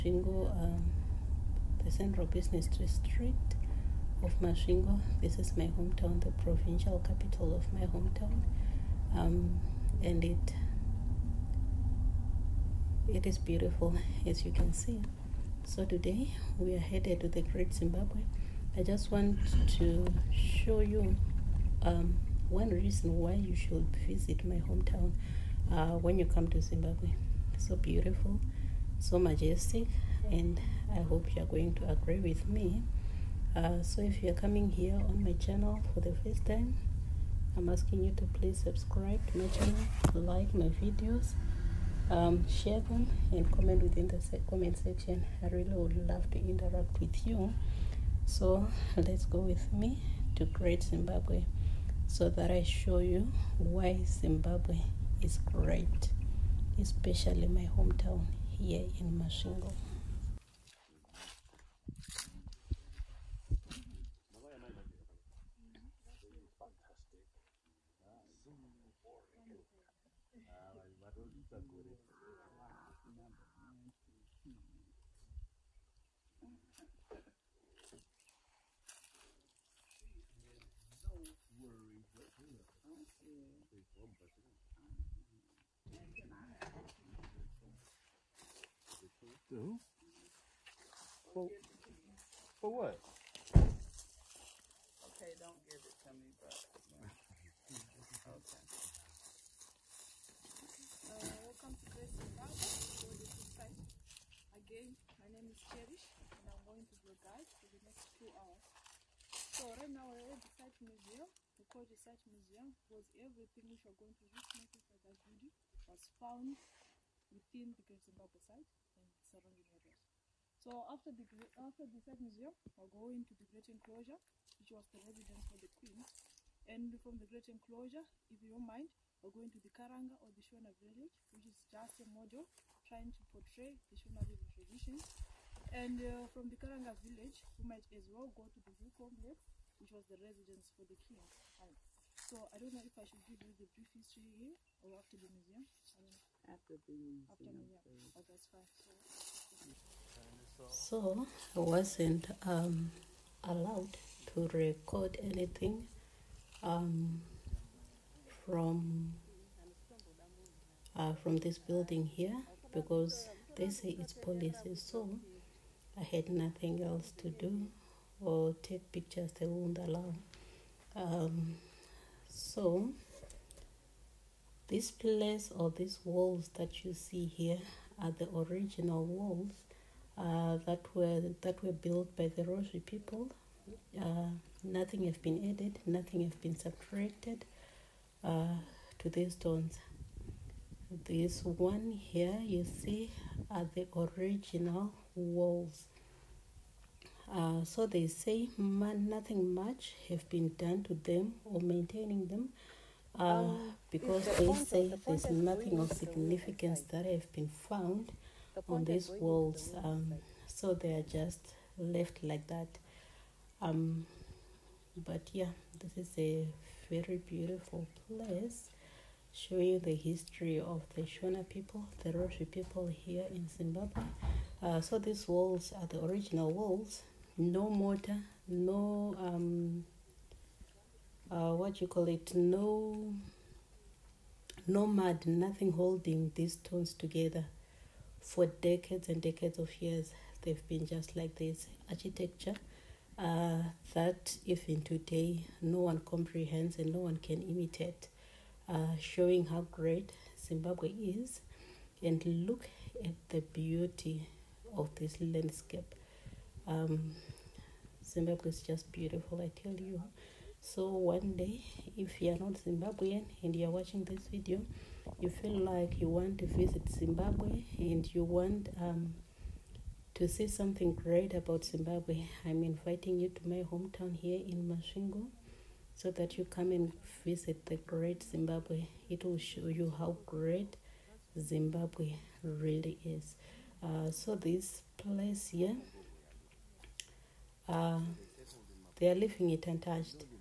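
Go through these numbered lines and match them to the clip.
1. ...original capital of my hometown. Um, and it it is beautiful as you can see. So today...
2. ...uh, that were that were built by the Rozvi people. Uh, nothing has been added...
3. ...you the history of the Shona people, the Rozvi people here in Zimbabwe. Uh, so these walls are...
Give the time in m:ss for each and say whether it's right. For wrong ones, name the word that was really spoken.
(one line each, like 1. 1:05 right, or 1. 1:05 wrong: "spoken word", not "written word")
1. 0:06 wrong: "provincial", not "original"
2. 3:00 right
3. 3:39 right.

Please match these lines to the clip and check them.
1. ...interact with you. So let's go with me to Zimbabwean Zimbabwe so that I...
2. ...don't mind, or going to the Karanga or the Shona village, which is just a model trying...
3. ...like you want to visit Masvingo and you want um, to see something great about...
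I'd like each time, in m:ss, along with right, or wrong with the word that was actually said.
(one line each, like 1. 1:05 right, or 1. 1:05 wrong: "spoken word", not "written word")
1. 0:46 wrong: "Great", not "Zimbabwean"
2. 2:08 right
3. 4:25 wrong: "Zimbabwe", not "Masvingo".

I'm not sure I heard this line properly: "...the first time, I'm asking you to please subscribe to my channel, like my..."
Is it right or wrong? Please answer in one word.
right.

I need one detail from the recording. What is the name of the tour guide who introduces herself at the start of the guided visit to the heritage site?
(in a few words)
Cherish.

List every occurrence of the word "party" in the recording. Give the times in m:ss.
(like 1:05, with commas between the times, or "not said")
not said.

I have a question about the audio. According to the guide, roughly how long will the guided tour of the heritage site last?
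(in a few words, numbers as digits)
two hours.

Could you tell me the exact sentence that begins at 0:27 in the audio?
So beautiful, so majestic, and I hope you are going to agree with me.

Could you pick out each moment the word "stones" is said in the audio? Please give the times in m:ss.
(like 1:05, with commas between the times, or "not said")
3:09, 3:56.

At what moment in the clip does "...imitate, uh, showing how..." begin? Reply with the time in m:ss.
4:07.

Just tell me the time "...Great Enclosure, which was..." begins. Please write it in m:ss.
2:03.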